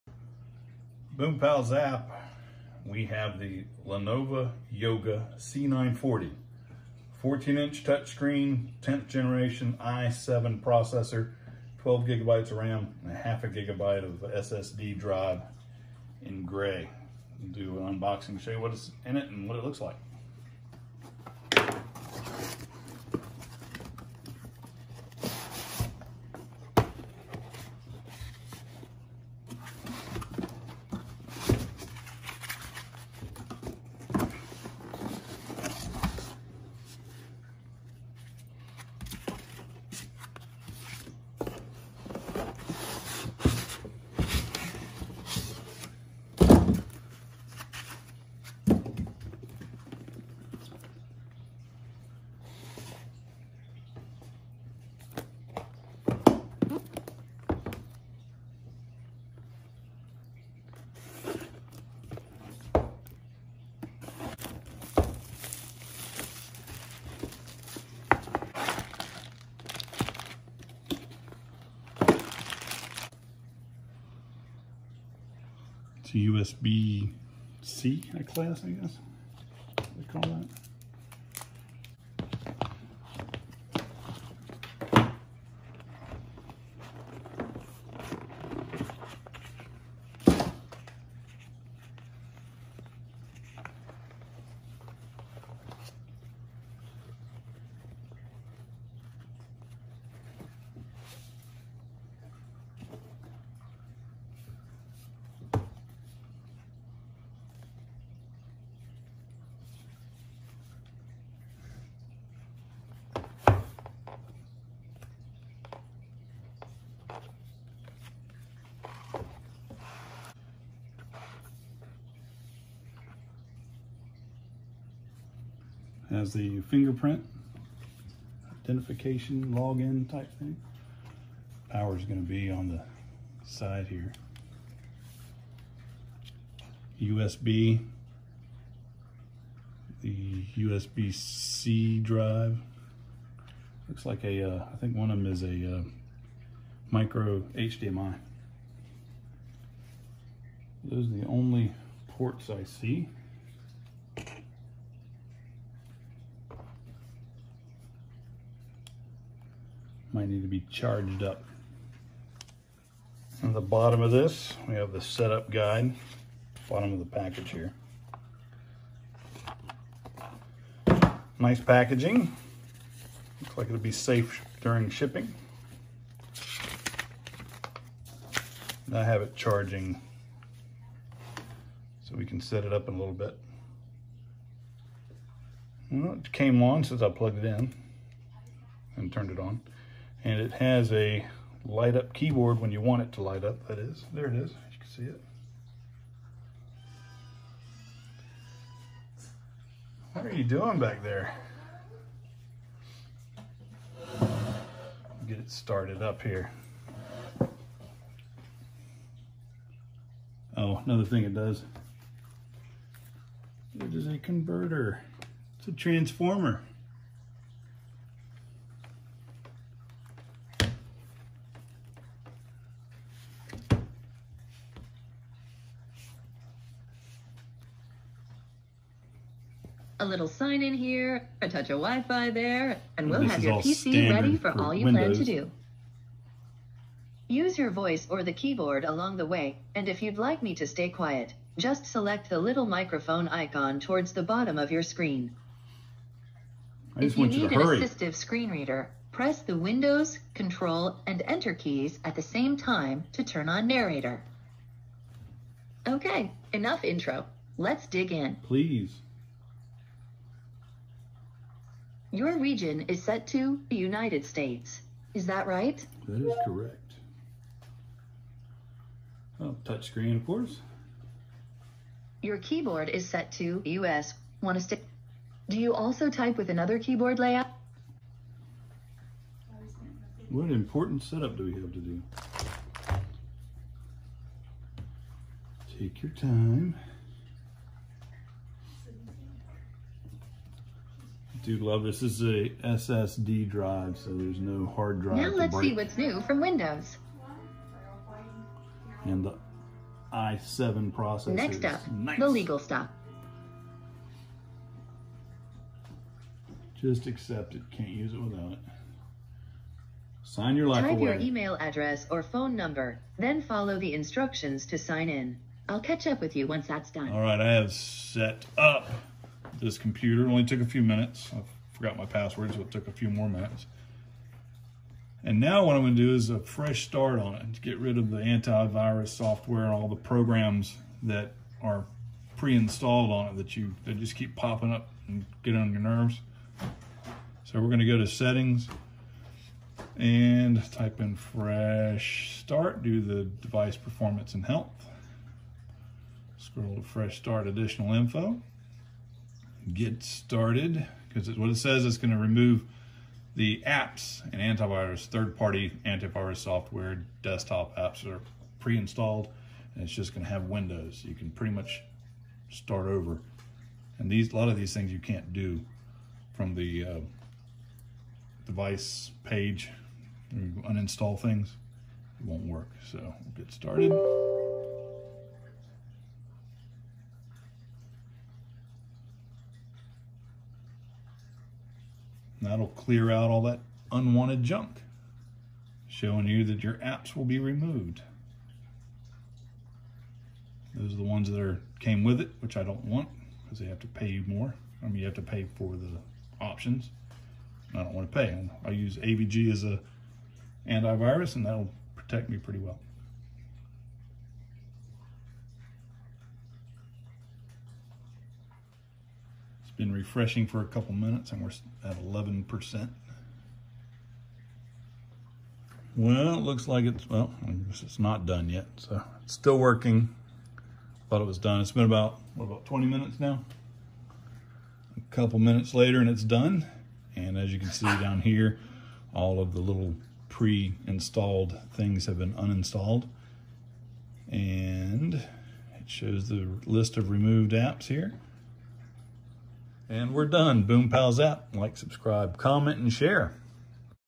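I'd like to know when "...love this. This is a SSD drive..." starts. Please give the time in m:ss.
4:51.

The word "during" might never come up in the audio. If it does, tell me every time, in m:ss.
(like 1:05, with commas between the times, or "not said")
2:54.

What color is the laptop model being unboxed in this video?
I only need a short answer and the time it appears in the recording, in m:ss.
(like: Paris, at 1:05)
gray, at 0:16.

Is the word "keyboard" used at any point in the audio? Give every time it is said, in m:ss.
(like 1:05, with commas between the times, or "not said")
3:12, 3:58, 4:32, 4:36.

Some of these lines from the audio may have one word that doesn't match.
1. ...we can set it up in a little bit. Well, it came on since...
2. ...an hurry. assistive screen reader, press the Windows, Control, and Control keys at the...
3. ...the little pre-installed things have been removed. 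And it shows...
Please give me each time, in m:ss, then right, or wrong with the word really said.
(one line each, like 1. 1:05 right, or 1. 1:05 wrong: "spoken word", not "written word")
1. 3:02 right
2. 4:07 wrong: "Enter", not "Control"
3. 7:09 wrong: "uninstalled", not "removed".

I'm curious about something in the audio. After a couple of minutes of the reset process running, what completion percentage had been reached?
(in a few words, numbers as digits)
11%.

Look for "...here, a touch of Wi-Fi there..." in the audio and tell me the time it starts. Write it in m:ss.
3:50.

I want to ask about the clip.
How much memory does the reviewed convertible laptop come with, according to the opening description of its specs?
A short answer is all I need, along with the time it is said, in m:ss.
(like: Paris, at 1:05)
12 gigabytes, at 0:11.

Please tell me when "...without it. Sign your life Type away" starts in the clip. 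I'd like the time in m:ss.
5:08.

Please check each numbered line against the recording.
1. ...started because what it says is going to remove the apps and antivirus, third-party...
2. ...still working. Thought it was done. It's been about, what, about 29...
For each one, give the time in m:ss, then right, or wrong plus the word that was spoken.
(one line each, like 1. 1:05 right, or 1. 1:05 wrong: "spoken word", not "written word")
1. 5:50 right
2. 6:59 wrong: "20", not "29".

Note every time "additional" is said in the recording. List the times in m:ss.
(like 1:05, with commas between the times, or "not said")
5:47.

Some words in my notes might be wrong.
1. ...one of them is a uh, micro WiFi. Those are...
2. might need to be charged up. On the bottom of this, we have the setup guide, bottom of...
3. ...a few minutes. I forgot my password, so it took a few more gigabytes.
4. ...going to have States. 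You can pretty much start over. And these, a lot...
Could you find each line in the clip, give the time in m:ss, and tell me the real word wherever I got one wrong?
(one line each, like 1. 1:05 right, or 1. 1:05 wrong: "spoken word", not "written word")
1. 2:24 wrong: "HDMI", not "WiFi"
2. 2:40 right
3. 5:20 wrong: "minutes", not "gigabytes"
4. 6:00 wrong: "Windows", not "States".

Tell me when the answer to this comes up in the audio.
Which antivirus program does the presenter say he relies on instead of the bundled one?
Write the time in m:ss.
6:38.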